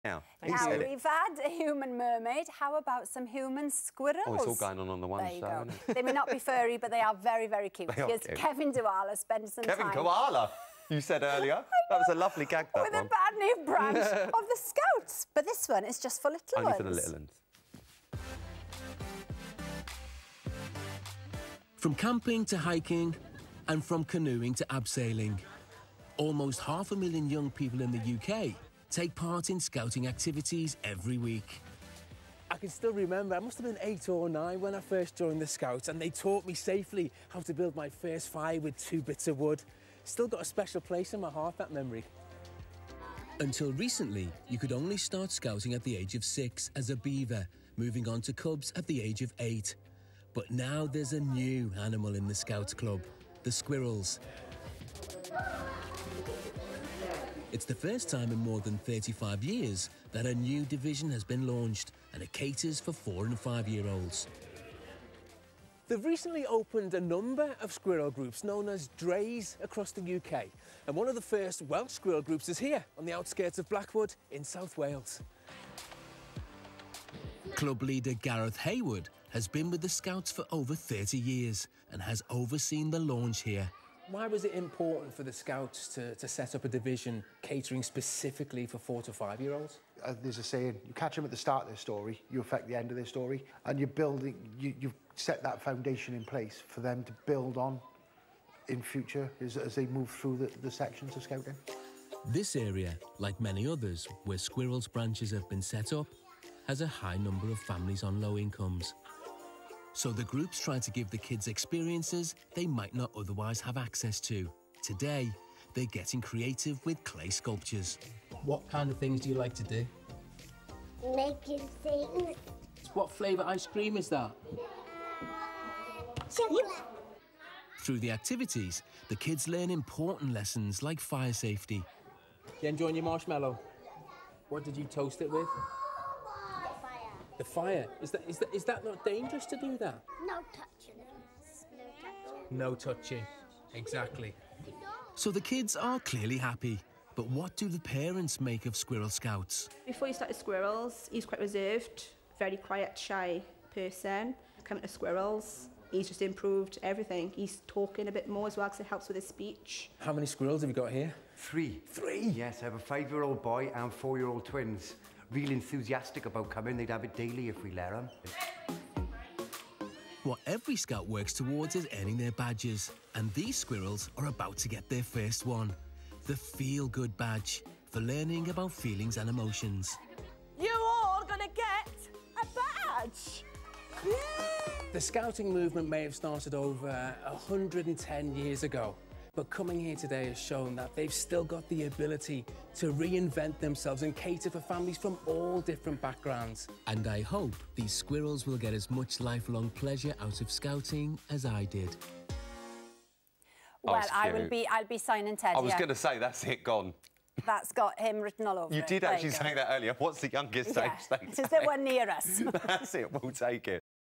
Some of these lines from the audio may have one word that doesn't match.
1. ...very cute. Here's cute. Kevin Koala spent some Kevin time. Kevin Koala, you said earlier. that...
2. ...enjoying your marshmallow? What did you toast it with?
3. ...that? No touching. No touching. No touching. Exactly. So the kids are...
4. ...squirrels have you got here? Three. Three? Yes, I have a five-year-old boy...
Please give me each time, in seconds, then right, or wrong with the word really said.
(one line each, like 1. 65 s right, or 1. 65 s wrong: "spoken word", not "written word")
1. 7 s right
2. 132 s right
3. 139 s right
4. 160 s right.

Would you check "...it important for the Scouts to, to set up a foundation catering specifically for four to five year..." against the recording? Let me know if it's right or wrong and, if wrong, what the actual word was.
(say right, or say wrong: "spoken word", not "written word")
wrong: "division", not "foundation".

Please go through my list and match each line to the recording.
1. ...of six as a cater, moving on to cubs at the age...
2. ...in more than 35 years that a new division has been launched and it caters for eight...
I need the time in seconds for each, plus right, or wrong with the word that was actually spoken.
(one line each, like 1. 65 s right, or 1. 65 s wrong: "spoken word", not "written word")
1. 46 s wrong: "beaver", not "cater"
2. 58 s wrong: "four", not "eight".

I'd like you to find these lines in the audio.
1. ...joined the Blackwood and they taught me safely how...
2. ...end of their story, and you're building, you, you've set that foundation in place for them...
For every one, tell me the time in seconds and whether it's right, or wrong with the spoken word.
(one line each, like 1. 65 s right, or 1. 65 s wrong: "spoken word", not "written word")
1. 35 s wrong: "Scouts", not "Blackwood"
2. 92 s right.